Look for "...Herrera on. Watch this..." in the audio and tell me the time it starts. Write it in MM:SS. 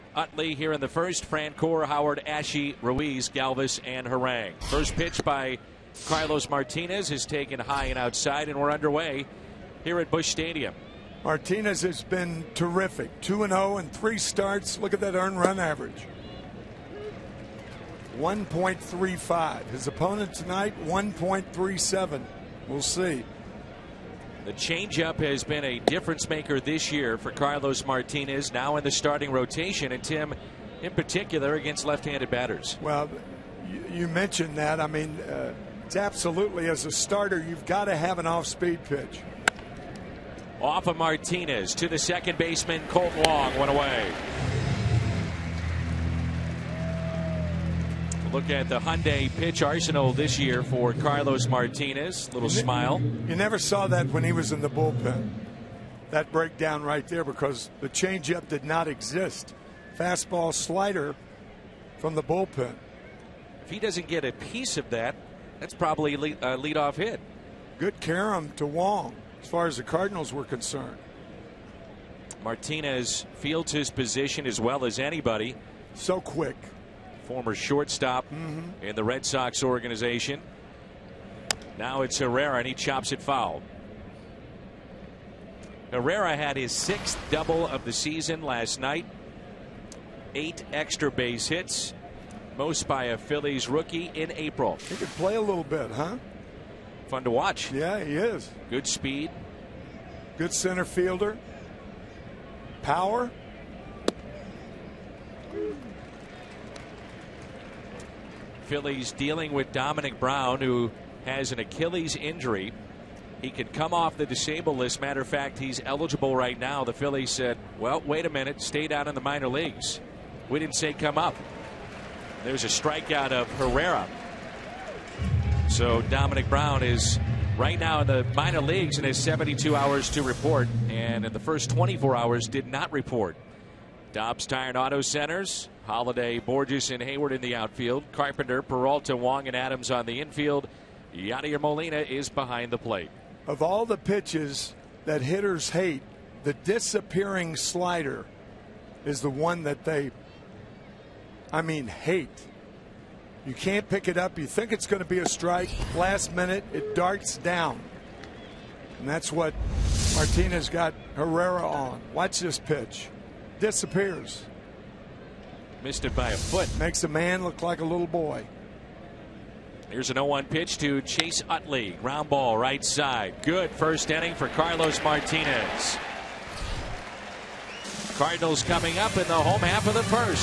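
02:41.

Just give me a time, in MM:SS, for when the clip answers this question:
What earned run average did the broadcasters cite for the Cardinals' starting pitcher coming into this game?
00:18.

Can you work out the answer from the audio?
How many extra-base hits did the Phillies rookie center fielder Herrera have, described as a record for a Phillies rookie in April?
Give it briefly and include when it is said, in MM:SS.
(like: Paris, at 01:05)
8, at 01:30.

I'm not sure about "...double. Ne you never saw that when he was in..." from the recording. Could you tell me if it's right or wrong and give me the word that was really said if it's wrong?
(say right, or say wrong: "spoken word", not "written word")
wrong: "smile", not "double".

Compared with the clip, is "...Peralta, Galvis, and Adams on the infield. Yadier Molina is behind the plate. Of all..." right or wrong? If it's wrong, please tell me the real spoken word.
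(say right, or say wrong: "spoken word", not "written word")
wrong: "Wong", not "Galvis".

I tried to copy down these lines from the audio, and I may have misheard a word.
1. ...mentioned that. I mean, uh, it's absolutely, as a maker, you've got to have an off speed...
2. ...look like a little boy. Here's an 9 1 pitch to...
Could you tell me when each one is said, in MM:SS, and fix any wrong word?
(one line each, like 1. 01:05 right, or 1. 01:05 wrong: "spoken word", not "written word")
1. 00:34 wrong: "starter", not "maker"
2. 02:47 wrong: "0", not "9".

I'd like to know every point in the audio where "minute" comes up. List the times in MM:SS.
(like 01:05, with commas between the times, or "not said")
01:58, 02:36.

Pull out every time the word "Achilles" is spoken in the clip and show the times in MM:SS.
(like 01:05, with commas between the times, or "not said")
01:51.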